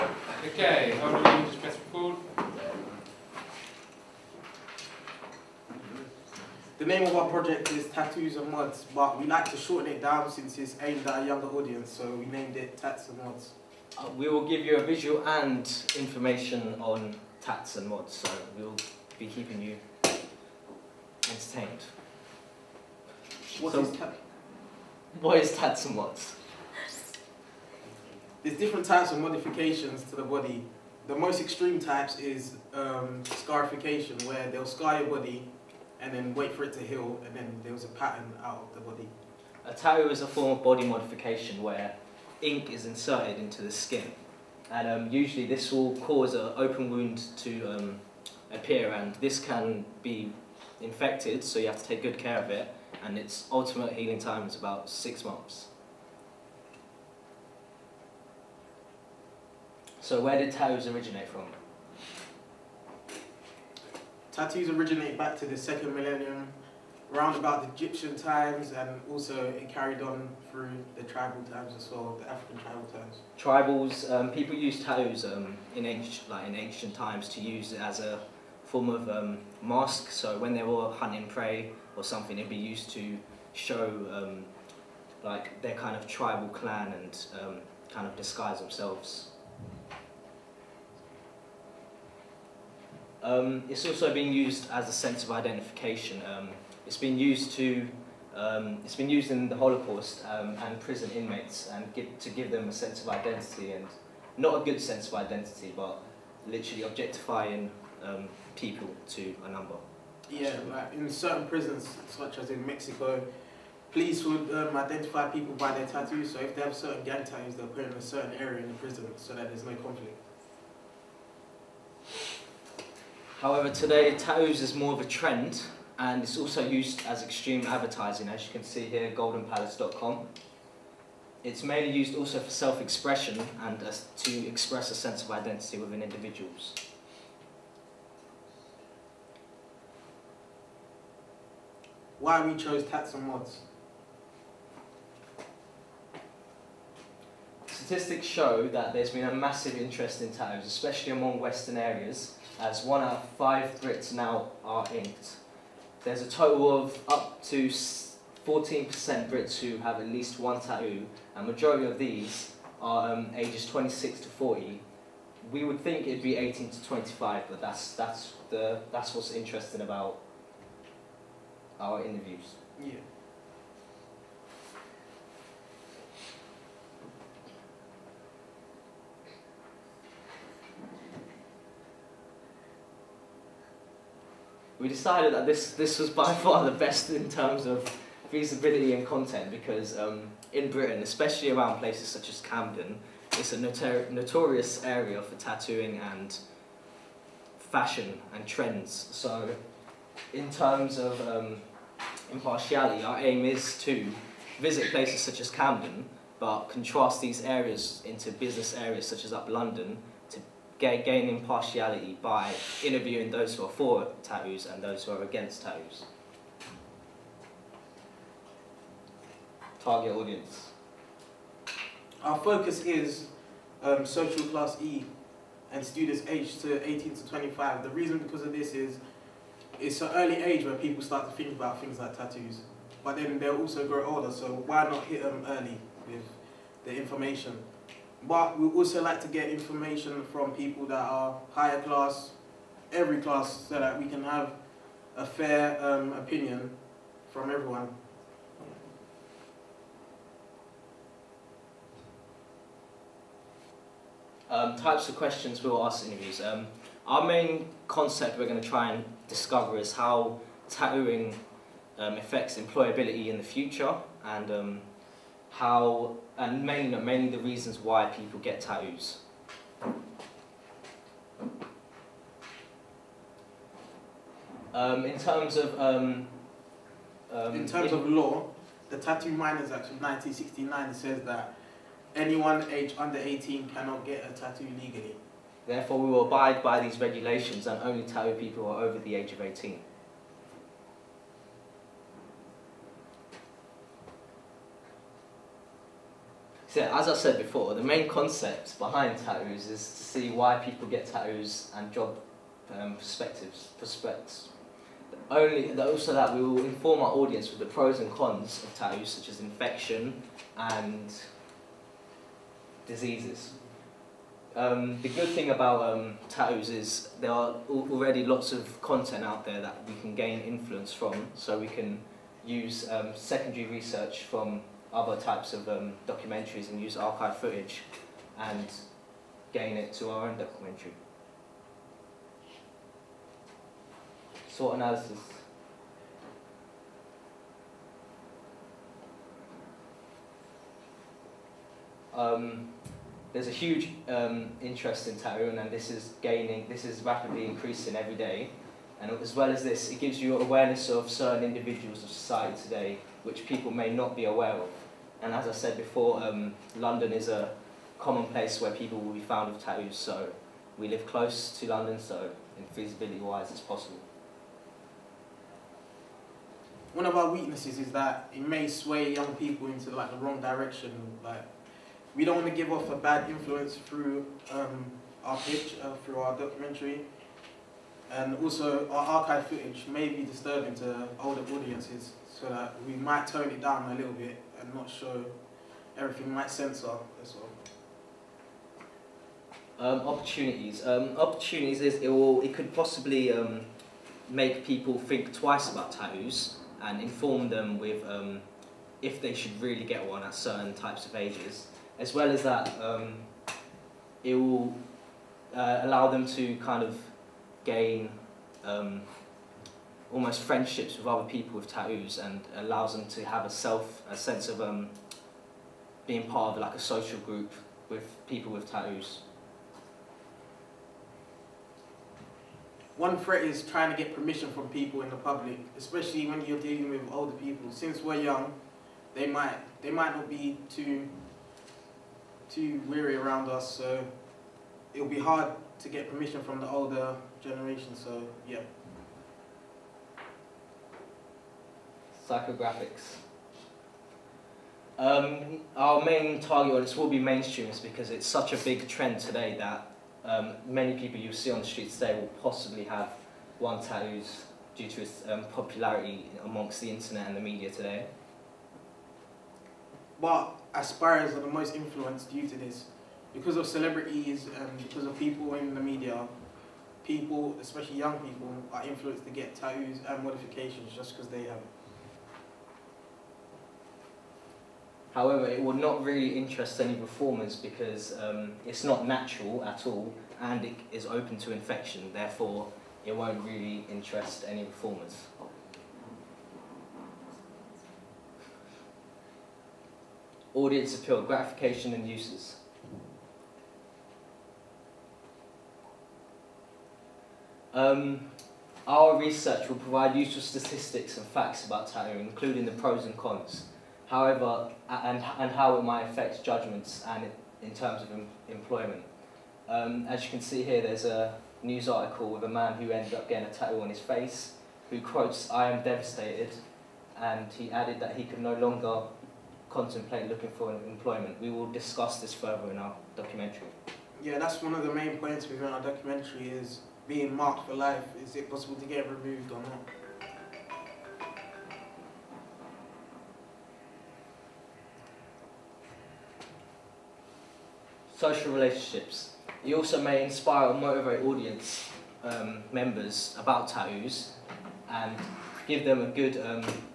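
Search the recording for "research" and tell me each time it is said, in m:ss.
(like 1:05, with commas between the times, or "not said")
5:23, 8:19.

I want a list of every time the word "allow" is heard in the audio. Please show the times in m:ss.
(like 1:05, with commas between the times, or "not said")
6:45, 6:52.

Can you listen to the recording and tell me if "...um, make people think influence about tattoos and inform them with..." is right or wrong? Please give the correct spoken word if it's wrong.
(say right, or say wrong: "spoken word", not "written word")
wrong: "twice", not "influence".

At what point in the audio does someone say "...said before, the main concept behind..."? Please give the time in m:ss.
4:57.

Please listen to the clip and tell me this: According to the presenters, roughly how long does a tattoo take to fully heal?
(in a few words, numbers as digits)
About six months.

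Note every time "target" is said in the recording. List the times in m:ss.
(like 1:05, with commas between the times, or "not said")
3:39, 7:26.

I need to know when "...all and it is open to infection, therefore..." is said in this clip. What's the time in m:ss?
7:59.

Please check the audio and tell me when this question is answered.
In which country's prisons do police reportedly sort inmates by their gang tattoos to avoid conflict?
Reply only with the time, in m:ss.
1:52.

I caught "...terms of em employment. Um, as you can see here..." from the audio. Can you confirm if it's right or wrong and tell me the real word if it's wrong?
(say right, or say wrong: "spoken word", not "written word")
right.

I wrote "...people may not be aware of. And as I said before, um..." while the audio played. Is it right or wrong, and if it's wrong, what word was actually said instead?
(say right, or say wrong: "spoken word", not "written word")
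right.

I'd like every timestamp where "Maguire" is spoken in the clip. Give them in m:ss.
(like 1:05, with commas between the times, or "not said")
not said.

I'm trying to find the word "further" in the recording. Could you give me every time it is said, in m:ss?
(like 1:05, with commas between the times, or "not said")
8:42.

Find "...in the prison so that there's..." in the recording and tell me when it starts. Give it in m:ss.
1:58.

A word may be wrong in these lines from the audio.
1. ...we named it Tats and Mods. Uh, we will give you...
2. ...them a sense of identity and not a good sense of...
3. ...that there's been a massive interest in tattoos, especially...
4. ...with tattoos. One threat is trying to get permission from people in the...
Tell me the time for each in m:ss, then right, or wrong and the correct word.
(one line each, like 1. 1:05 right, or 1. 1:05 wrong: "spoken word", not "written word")
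1. 0:12 right
2. 1:42 right
3. 2:28 right
4. 6:58 right.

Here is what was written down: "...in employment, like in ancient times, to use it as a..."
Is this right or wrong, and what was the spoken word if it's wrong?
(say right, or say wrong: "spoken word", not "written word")
wrong: "ancient", not "employment".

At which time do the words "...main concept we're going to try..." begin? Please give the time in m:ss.
4:17.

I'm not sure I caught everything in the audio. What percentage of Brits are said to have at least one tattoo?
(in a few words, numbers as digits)
14%.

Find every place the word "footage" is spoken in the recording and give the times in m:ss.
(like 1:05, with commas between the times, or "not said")
5:27, 6:19.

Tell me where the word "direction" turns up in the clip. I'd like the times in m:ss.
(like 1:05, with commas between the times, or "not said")
6:10.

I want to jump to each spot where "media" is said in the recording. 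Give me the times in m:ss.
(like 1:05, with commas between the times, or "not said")
7:37, 7:45.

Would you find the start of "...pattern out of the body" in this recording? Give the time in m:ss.
0:37.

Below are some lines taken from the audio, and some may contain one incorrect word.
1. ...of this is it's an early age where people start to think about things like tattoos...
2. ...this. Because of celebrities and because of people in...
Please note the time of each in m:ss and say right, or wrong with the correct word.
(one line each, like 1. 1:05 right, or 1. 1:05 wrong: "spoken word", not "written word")
1. 3:48 right
2. 7:42 right.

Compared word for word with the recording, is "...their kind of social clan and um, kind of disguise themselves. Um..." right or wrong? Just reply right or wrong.
wrong.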